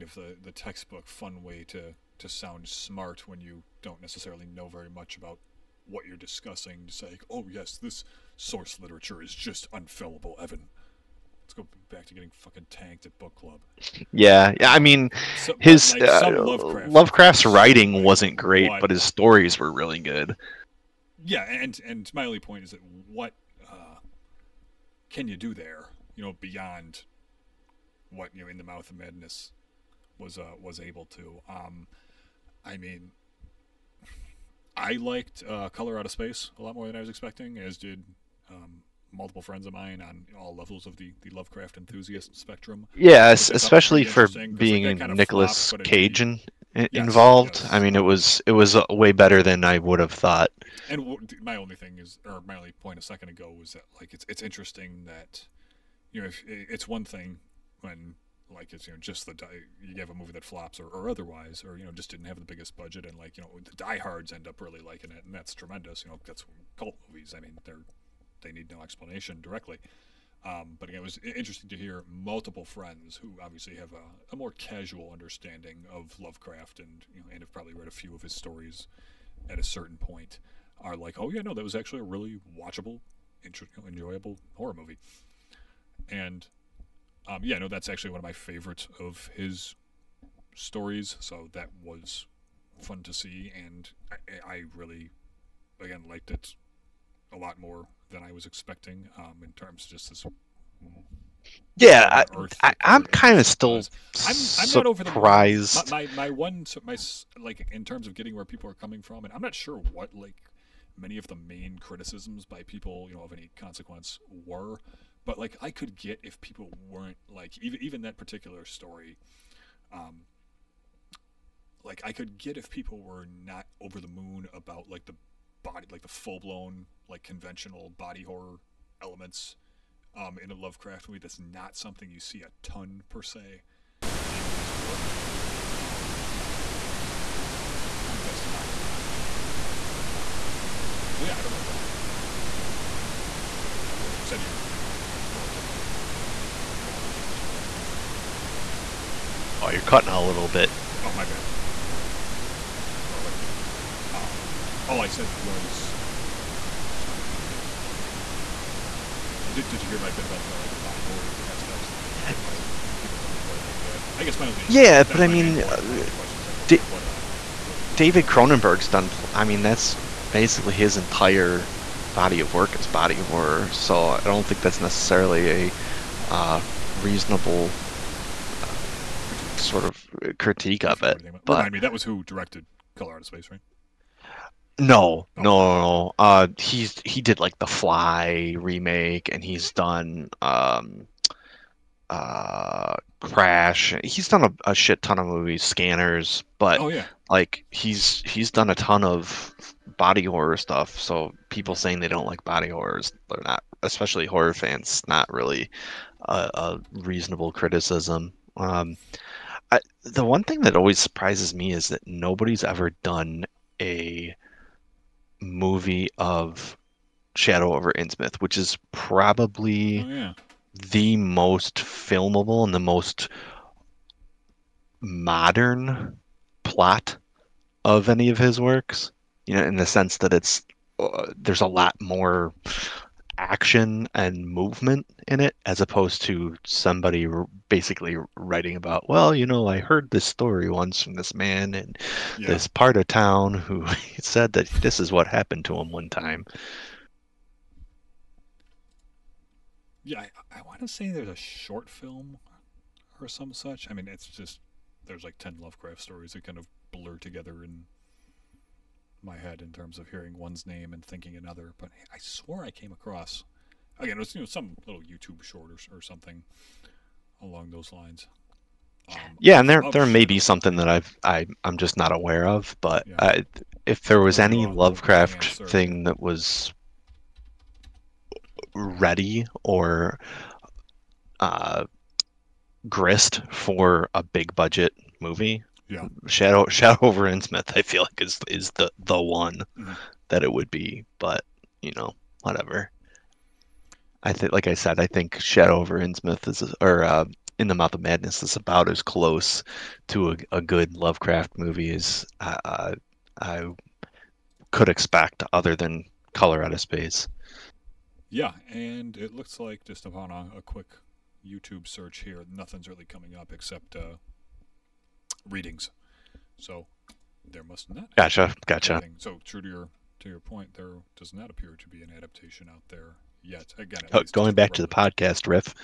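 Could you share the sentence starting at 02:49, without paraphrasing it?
I mean, that's basically his entire body of work is body horror, so I don't think that's necessarily a uh, reasonable.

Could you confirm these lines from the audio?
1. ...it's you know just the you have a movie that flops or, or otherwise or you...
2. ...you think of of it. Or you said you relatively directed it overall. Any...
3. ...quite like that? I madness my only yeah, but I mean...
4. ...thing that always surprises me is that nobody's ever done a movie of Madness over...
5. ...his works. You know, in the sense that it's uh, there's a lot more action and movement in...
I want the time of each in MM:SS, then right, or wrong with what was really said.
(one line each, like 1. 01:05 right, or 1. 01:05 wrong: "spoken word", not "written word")
1. 00:58 right
2. 02:22 wrong: "enjoyed", not "directed"
3. 02:43 wrong: "guess", not "madness"
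4. 03:30 wrong: "Shadow", not "Madness"
5. 03:48 right.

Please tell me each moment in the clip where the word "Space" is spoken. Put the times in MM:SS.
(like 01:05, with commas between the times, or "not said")
00:36, 03:03, 05:06.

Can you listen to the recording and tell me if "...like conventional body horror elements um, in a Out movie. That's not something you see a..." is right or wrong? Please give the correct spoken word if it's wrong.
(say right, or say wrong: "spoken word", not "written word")
wrong: "Lovecraft", not "Out".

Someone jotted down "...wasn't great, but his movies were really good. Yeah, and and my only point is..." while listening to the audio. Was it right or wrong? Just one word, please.
wrong.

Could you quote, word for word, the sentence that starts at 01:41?
Yeah, I, am kind of still I'm, I'm not over the surprised.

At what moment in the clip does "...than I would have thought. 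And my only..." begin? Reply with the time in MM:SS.
00:49.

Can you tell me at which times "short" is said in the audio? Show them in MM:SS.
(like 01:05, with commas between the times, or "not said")
04:11, 04:25.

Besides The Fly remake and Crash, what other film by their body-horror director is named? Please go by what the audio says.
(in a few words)
Scanners.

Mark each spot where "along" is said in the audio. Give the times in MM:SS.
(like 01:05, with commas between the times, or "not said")
04:27.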